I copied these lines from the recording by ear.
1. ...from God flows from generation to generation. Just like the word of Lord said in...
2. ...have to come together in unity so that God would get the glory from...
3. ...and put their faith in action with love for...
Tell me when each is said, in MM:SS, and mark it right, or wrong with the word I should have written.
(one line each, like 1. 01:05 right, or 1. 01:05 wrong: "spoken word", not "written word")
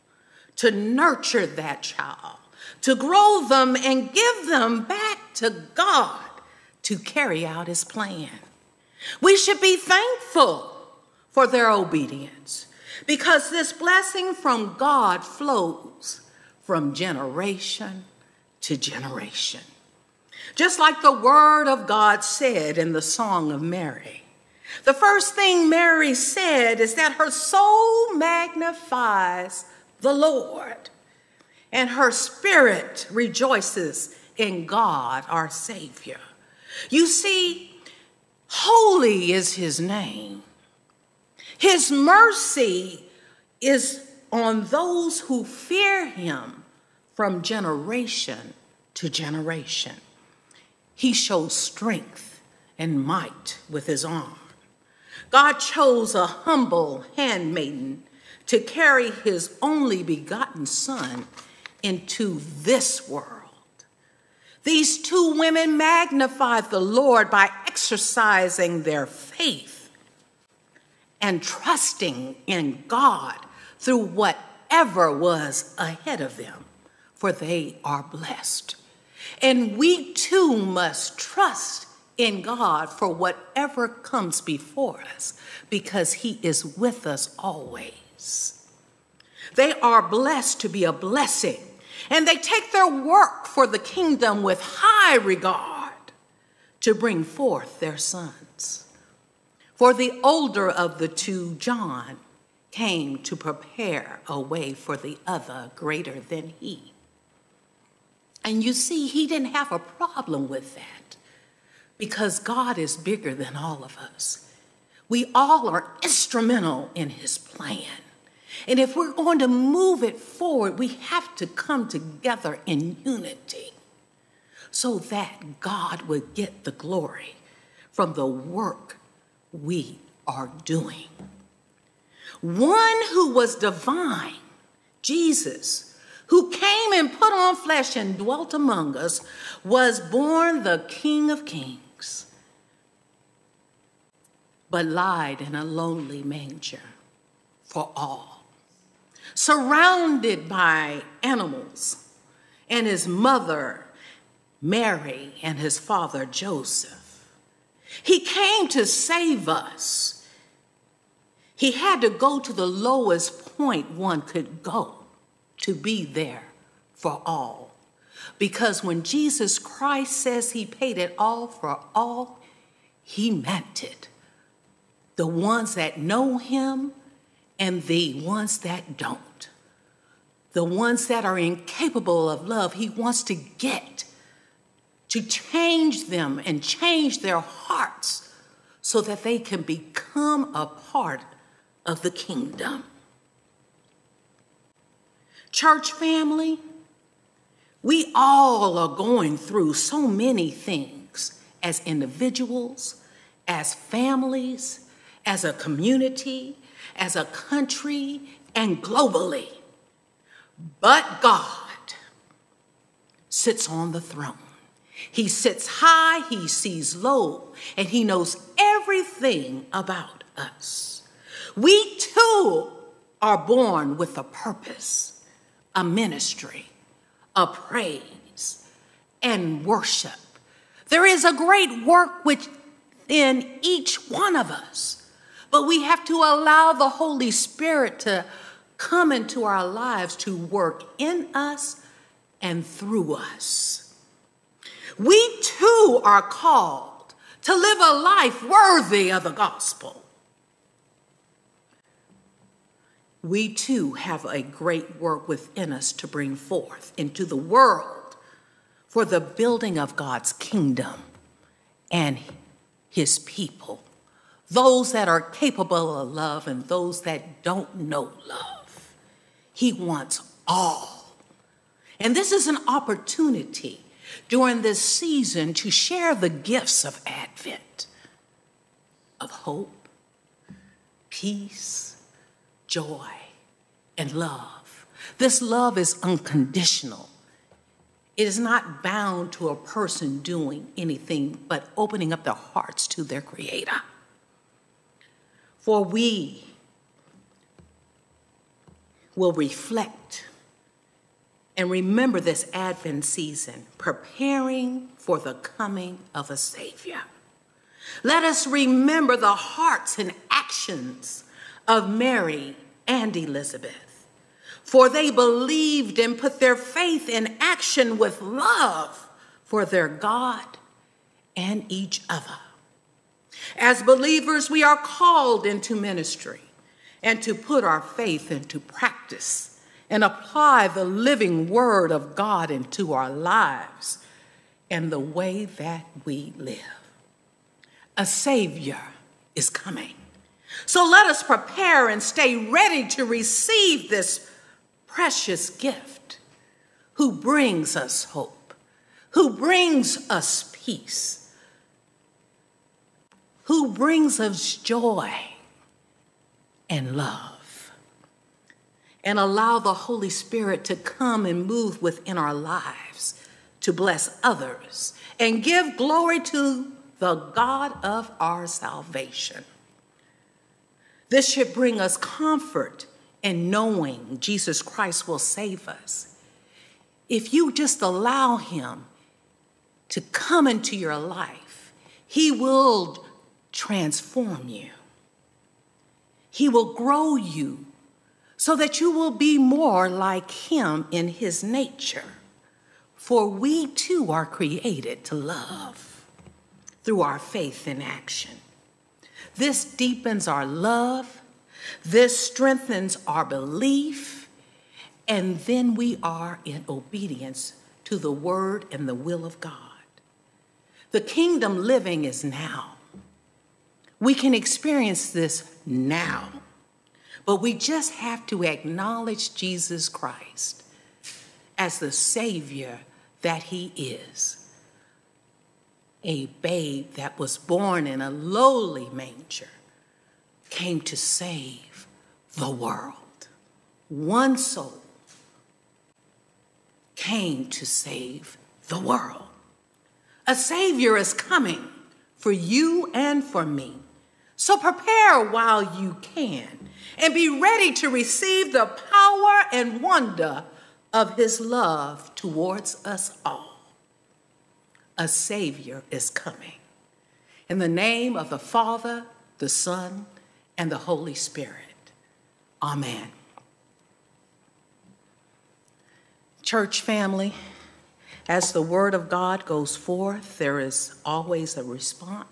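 1. 00:14 wrong: "God", not "Lord"
2. 02:00 right
3. 05:15 right.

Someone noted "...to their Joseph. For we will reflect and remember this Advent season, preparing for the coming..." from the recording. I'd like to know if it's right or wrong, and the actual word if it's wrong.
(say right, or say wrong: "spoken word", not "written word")
wrong: "Creator", not "Joseph".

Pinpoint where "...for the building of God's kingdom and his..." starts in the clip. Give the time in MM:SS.
04:18.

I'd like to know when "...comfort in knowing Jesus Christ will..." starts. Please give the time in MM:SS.
06:11.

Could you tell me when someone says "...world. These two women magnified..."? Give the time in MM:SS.
01:03.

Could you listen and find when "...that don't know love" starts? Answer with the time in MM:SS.
04:27.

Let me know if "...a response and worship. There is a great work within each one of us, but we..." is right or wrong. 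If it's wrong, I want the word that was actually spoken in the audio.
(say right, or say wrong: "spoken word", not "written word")
wrong: "praise", not "response".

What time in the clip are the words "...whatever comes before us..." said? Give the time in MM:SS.
01:23.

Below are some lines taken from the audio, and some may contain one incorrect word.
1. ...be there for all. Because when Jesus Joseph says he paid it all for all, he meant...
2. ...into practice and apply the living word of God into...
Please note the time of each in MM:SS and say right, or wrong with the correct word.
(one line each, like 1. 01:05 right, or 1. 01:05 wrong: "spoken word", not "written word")
1. 02:45 wrong: "Christ", not "Joseph"
2. 05:28 right.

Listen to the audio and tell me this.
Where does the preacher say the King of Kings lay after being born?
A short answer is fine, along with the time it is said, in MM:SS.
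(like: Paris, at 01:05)
a lonely manger, at 02:25.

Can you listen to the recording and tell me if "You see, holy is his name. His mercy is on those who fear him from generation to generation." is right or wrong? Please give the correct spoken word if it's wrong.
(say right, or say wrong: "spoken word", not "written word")
right.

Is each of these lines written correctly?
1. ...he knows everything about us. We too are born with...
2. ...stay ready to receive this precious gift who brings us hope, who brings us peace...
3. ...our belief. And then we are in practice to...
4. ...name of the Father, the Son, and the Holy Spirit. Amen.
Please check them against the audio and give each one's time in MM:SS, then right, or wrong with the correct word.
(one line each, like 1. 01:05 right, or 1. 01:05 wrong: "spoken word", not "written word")
1. 03:37 right
2. 05:42 right
3. 06:43 wrong: "obedience", not "practice"
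4. 07:37 right.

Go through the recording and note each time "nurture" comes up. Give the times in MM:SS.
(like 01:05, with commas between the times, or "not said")
00:00.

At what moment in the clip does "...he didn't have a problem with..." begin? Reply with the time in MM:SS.
01:49.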